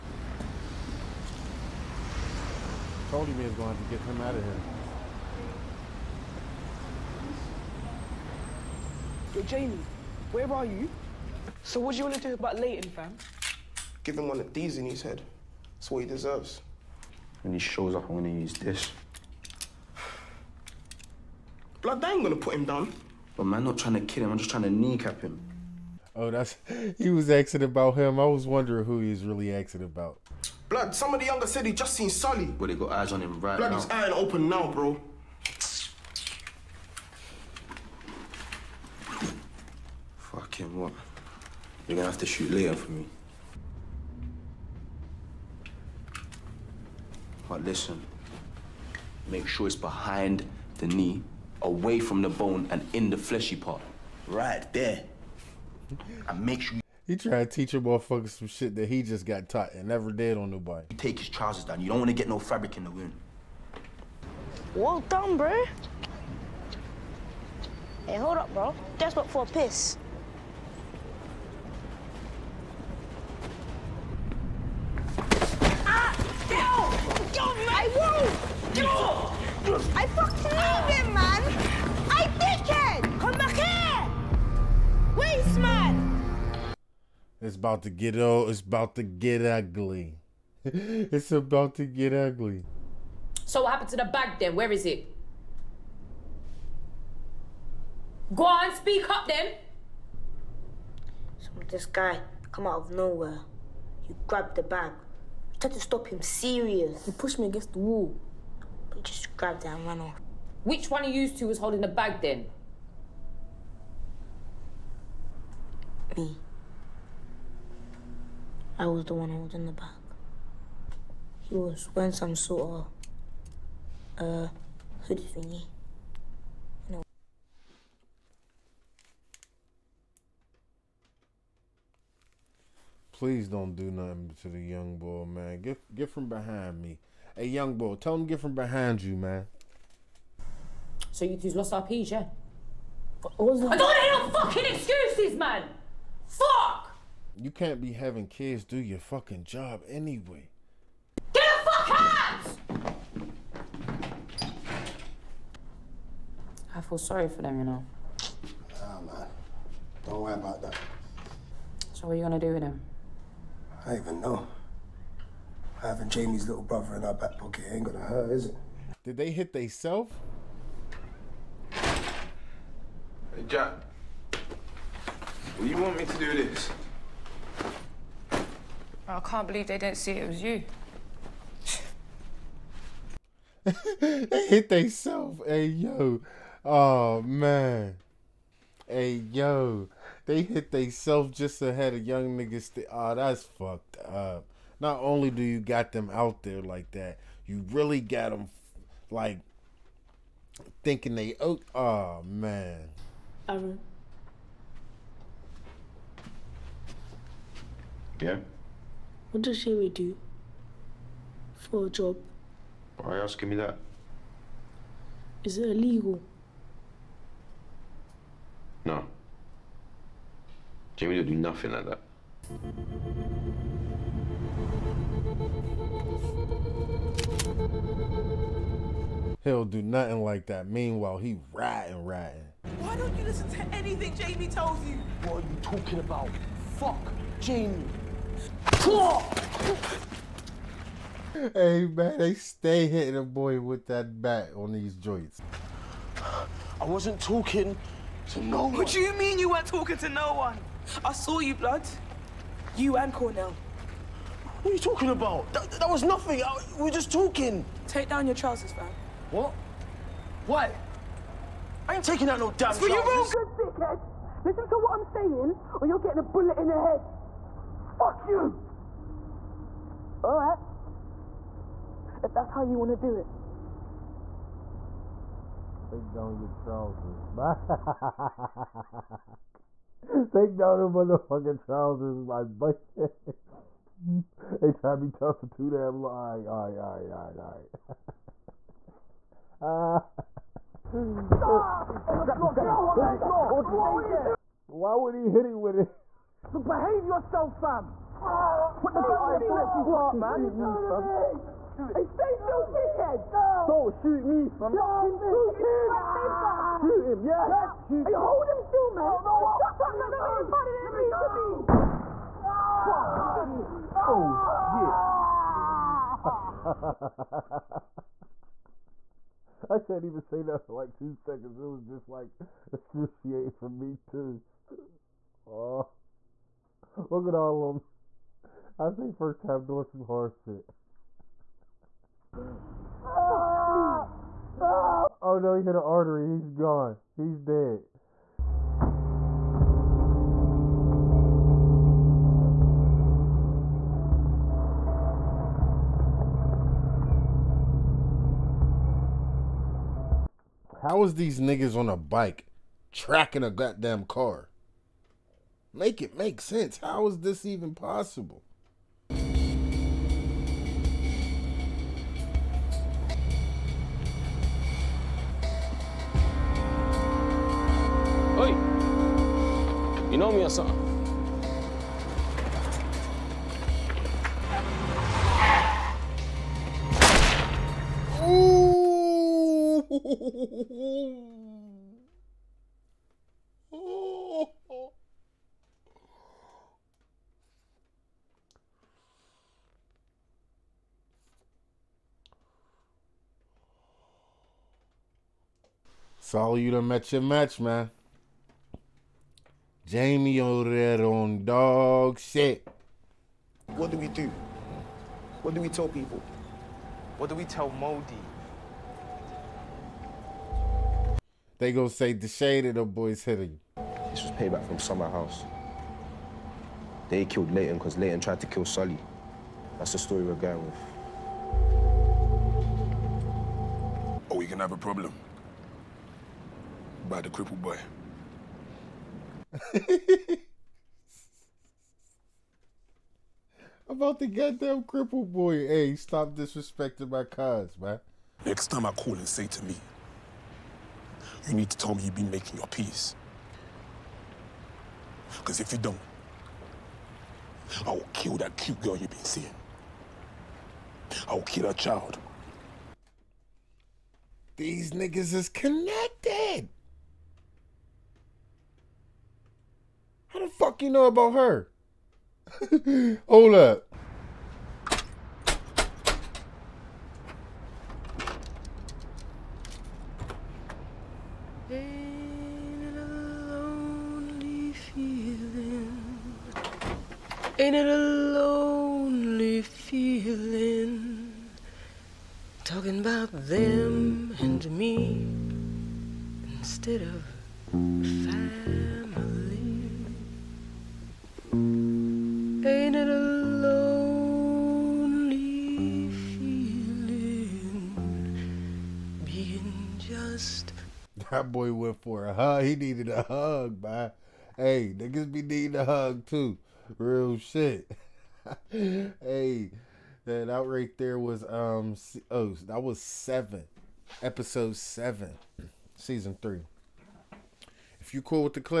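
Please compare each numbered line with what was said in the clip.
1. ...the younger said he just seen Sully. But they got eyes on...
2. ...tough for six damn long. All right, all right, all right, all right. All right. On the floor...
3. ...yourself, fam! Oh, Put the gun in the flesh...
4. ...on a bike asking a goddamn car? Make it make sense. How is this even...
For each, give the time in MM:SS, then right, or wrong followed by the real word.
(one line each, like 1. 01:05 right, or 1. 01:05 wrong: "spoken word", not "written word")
1. 00:31 right
2. 04:45 wrong: "two", not "six"
3. 04:57 right
4. 05:51 wrong: "tracking", not "asking".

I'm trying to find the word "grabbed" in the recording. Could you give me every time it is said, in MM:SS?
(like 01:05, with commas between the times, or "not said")
01:44, 01:49.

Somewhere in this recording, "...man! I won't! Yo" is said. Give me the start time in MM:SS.
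01:17.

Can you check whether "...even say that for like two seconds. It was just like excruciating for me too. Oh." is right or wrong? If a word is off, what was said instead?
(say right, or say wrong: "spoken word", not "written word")
right.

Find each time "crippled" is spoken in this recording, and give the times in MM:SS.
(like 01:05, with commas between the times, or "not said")
07:07, 07:14.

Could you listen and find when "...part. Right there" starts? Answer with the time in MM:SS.
00:53.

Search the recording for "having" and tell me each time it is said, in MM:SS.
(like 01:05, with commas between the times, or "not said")
02:27, 02:45.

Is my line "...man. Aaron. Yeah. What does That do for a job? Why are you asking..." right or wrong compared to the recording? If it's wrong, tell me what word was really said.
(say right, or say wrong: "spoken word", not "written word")
wrong: "Jamie", not "That".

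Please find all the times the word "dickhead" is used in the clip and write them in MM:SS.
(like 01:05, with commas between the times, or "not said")
04:23, 05:02.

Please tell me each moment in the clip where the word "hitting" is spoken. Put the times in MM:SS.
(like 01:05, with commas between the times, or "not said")
04:02, 06:53.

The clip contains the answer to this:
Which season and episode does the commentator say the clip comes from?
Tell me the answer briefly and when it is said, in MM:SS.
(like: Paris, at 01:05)
Episode 7, season 3, at 08:34.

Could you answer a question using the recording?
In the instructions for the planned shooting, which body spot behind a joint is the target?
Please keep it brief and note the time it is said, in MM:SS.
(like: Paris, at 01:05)
behind the knee, at 00:49.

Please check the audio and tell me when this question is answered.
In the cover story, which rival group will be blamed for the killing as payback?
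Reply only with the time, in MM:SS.
06:54.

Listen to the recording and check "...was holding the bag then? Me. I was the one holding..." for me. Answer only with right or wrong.
right.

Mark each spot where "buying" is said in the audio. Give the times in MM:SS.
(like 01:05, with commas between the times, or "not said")
not said.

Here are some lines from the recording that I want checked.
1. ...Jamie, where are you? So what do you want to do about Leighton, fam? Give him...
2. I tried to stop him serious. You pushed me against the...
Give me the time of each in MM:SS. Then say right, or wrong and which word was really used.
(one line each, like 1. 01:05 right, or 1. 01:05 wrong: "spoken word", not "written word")
1. 00:09 right
2. 01:45 right.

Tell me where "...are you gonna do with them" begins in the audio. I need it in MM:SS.
02:42.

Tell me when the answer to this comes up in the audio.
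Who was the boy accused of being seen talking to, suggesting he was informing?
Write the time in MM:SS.
04:13.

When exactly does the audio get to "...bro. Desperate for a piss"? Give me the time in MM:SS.
01:08.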